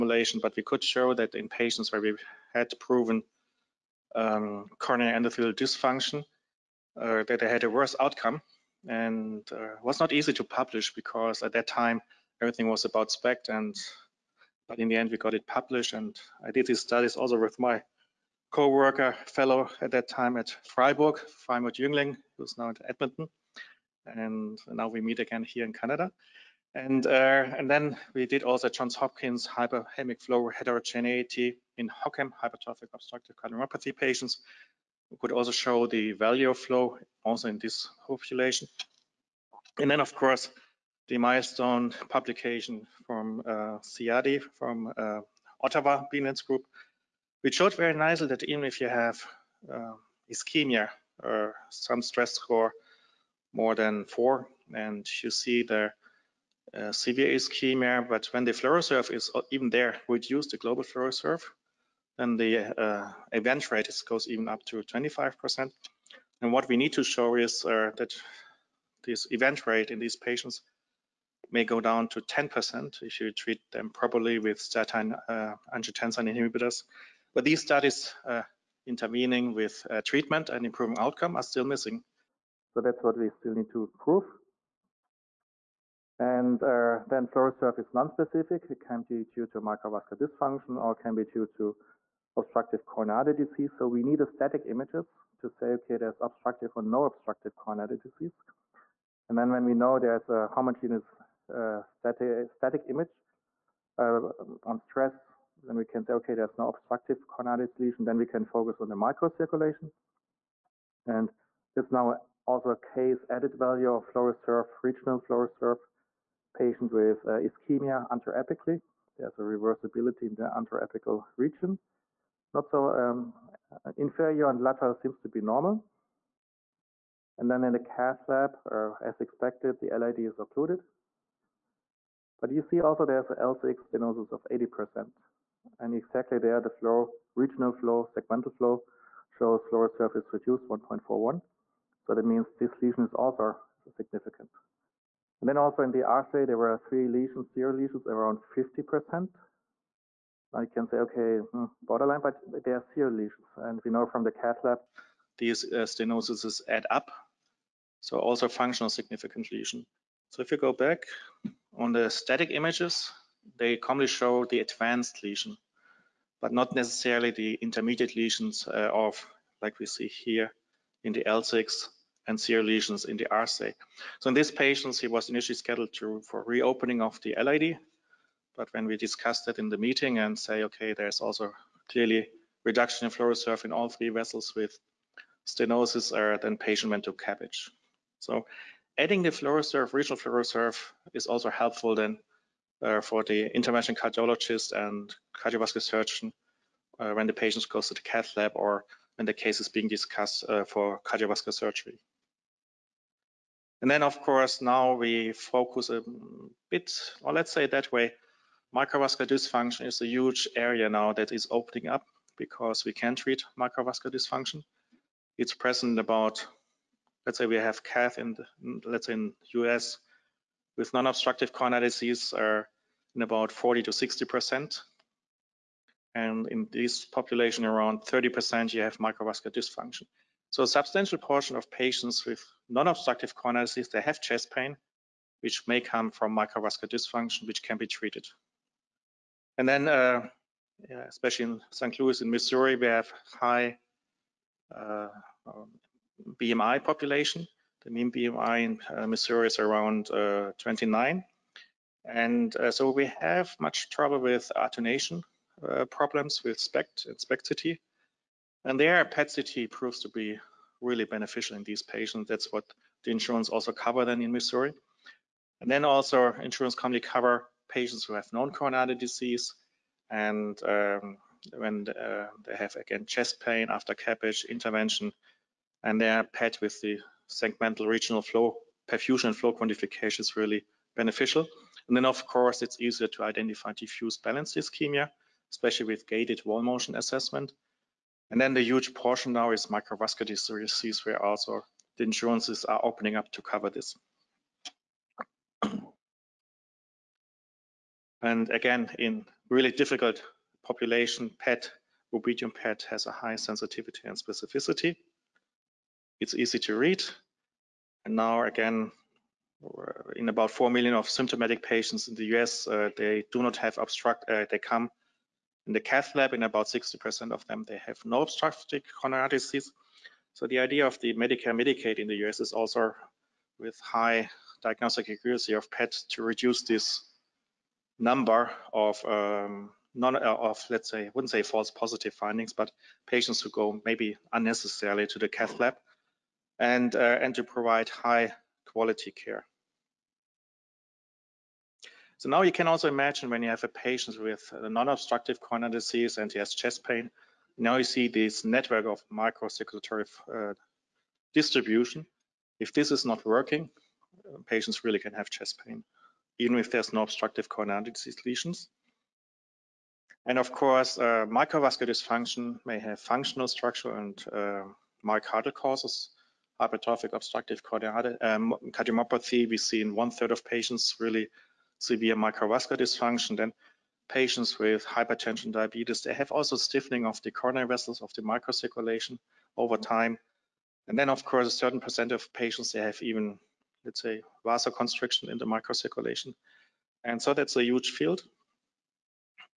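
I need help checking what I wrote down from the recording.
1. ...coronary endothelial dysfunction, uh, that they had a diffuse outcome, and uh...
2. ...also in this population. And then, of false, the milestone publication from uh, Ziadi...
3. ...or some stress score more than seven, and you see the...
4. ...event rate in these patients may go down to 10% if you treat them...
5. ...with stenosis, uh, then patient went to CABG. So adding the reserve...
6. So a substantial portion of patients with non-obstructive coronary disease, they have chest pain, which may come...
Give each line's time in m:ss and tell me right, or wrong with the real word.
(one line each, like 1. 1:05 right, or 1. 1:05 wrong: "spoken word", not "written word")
1. 0:04 wrong: "worse", not "diffuse"
2. 0:37 wrong: "course", not "false"
3. 0:51 wrong: "four", not "seven"
4. 1:09 right
5. 3:04 right
6. 3:50 right.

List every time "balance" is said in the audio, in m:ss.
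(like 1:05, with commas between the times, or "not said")
4:44.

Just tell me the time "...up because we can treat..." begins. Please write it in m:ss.
3:31.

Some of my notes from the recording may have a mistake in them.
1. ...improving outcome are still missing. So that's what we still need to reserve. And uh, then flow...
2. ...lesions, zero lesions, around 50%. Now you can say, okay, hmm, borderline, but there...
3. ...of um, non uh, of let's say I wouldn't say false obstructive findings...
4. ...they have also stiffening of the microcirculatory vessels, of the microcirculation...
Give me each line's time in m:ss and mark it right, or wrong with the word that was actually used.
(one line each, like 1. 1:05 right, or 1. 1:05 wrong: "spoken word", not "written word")
1. 1:20 wrong: "prove", not "reserve"
2. 2:27 right
3. 5:28 wrong: "positive", not "obstructive"
4. 6:16 wrong: "coronary", not "microcirculatory".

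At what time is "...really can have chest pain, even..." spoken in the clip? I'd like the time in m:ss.
5:54.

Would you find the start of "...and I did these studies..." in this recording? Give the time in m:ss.
0:15.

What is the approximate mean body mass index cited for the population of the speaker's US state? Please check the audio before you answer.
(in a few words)
29.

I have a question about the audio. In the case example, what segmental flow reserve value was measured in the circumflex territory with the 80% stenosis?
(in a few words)
1.41.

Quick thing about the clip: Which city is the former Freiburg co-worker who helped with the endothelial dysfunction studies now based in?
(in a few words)
Edmonton.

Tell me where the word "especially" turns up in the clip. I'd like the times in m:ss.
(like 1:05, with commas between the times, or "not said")
4:01, 4:45.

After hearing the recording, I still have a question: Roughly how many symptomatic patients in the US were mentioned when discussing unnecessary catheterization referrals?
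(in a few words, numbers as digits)
4 million.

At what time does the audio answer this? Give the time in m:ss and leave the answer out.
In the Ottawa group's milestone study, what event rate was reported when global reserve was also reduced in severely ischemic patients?
1:04.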